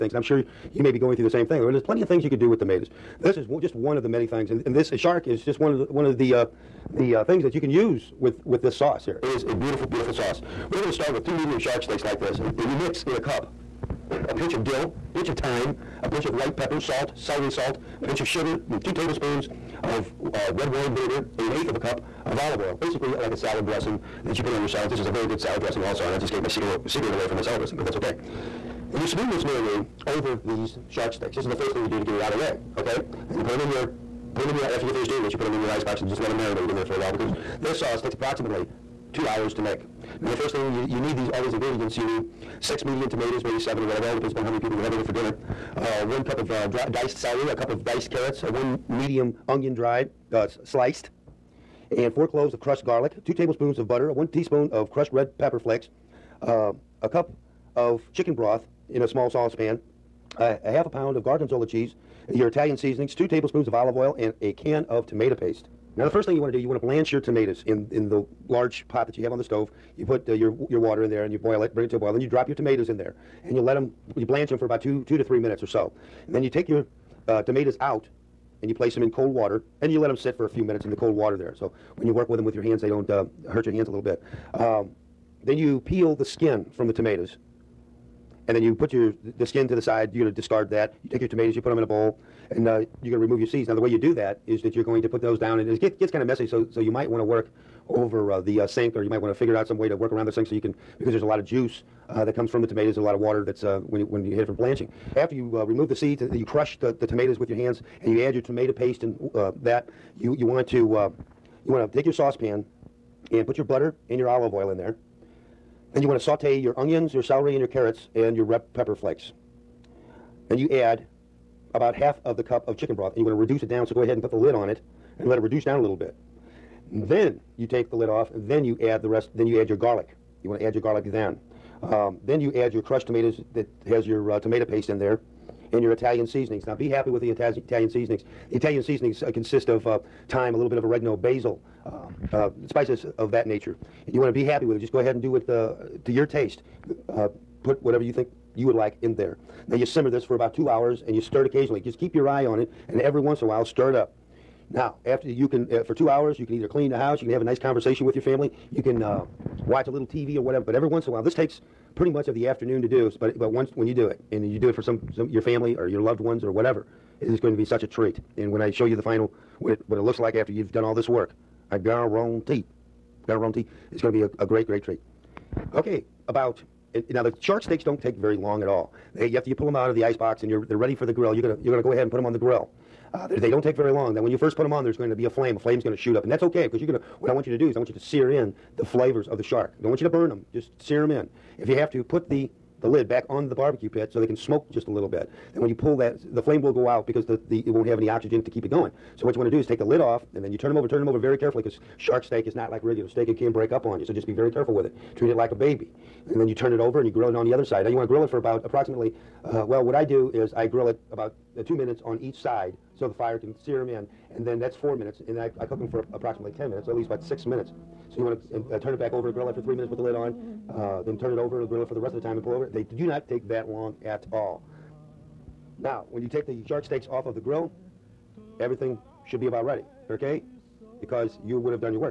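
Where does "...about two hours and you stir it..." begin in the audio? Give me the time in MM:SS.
02:30.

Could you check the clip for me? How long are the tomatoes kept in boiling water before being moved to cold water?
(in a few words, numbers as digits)
2 to 3 minutes.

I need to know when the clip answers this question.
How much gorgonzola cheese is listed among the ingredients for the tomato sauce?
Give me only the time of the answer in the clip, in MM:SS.
01:00.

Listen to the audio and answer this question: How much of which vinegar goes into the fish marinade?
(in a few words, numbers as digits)
2 tablespoons red wine vinegar.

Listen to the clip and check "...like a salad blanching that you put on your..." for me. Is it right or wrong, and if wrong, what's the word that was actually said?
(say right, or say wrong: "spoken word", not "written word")
wrong: "dressing", not "blanching".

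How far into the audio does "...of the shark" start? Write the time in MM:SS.
03:09.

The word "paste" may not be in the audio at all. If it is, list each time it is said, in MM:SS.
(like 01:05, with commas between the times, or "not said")
01:05, 01:48, 02:14.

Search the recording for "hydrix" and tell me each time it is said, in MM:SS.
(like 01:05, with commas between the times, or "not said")
not said.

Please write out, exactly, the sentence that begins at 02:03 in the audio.
So go ahead and put the lid on it and let it reduce down a little bit.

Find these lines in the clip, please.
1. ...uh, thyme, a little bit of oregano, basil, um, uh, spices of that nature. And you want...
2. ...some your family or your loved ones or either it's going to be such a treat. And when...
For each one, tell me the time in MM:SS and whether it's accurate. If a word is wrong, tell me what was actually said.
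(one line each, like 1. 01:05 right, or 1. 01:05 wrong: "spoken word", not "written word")
1. 02:19 right
2. 02:45 wrong: "whatever", not "either".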